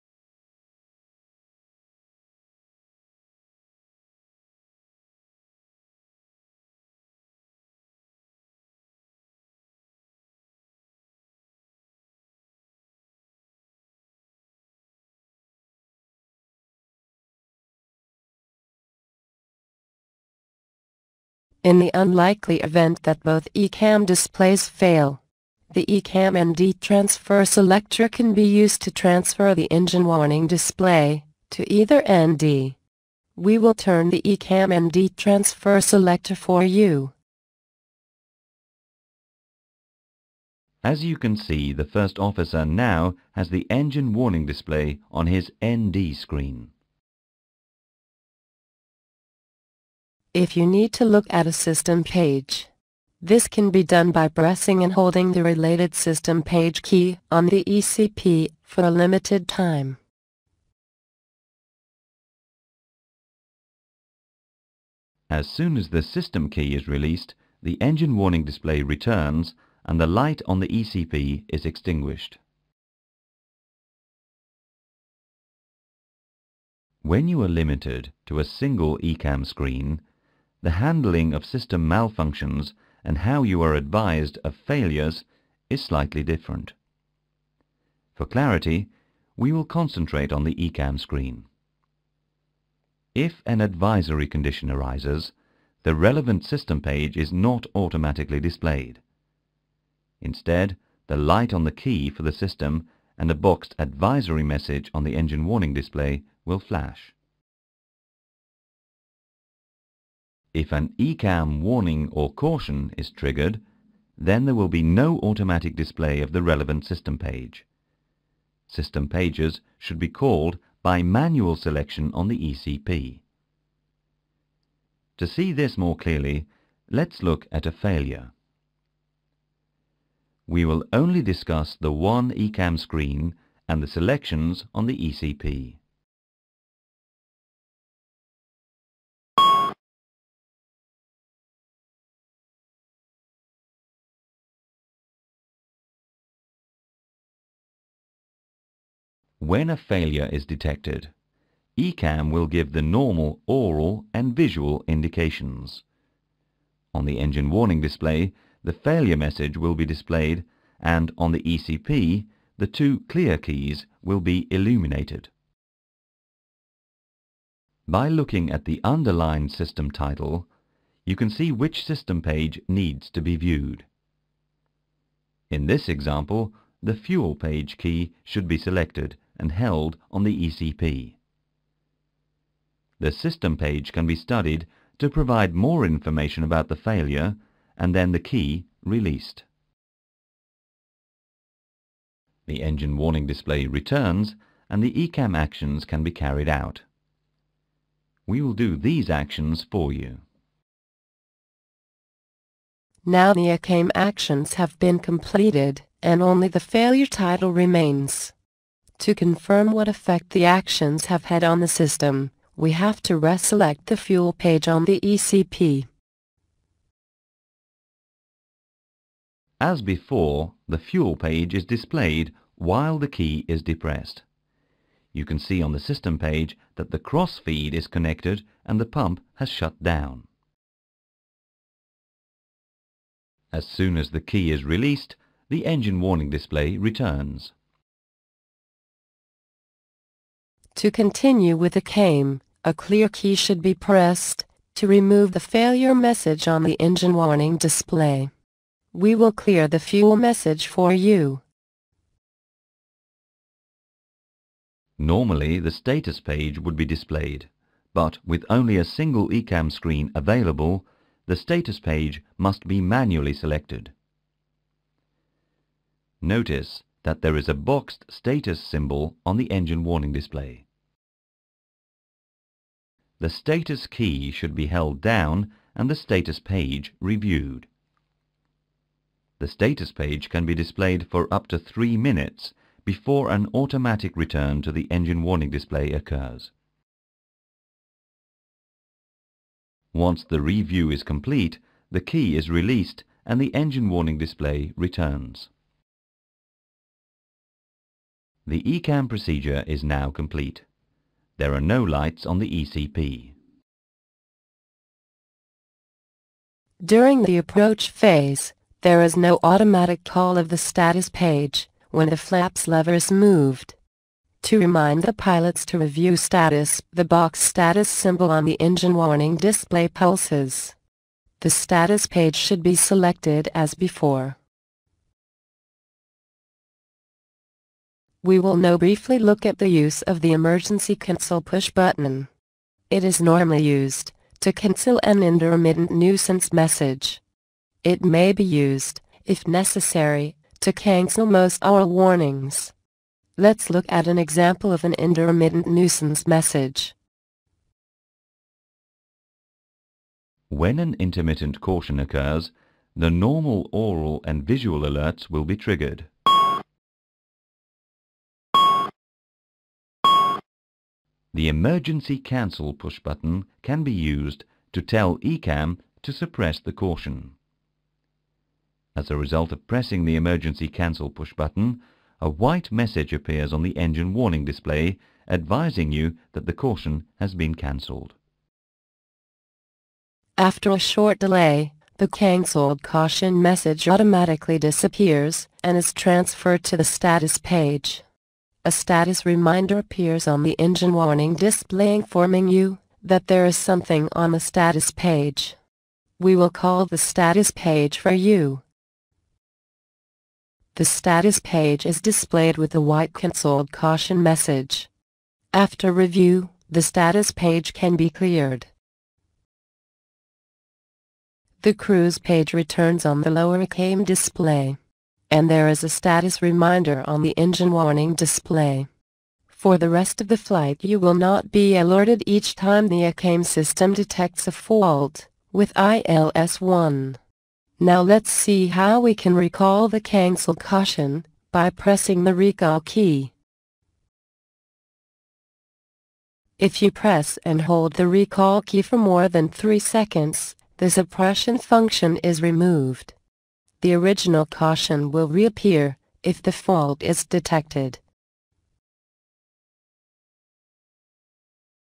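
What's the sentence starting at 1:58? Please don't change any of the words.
System pages should be called by manual selection on the ECP.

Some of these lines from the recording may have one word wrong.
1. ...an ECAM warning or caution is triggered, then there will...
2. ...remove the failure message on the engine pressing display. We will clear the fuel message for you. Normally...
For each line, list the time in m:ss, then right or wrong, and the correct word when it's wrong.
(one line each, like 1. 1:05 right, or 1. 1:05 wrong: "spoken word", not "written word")
1. 1:50 right
2. 4:04 wrong: "warning", not "pressing".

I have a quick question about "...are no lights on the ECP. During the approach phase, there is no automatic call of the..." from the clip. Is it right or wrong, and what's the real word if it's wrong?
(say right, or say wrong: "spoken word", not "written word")
right.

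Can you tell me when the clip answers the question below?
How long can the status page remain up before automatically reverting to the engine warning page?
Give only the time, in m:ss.
4:41.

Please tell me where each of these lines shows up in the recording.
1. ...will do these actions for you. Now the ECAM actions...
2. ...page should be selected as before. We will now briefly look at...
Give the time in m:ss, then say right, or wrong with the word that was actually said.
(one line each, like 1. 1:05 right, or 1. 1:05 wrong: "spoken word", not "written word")
1. 3:18 right
2. 5:22 right.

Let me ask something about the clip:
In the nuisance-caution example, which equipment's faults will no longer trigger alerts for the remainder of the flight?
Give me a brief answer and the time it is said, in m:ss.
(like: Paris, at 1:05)
ILS-1, at 7:05.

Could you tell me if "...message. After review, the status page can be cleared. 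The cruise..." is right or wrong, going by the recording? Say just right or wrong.
right.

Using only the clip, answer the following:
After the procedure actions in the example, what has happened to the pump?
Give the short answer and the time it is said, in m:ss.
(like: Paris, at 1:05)
shut down, at 3:49.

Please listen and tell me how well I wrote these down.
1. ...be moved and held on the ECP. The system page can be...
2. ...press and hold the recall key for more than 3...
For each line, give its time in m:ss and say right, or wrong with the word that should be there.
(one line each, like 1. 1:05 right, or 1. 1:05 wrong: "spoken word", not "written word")
1. 2:58 wrong: "selected", not "moved"
2. 7:16 right.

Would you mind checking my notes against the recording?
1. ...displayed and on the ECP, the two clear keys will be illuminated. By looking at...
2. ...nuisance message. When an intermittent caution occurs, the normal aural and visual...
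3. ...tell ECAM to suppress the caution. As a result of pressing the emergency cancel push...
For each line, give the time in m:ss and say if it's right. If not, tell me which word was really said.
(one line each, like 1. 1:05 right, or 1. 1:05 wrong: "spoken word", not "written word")
1. 2:39 right
2. 5:45 right
3. 6:04 right.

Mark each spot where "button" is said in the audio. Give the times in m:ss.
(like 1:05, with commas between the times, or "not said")
5:31, 6:02, 6:11.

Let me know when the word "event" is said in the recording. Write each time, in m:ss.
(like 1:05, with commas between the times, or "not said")
0:22.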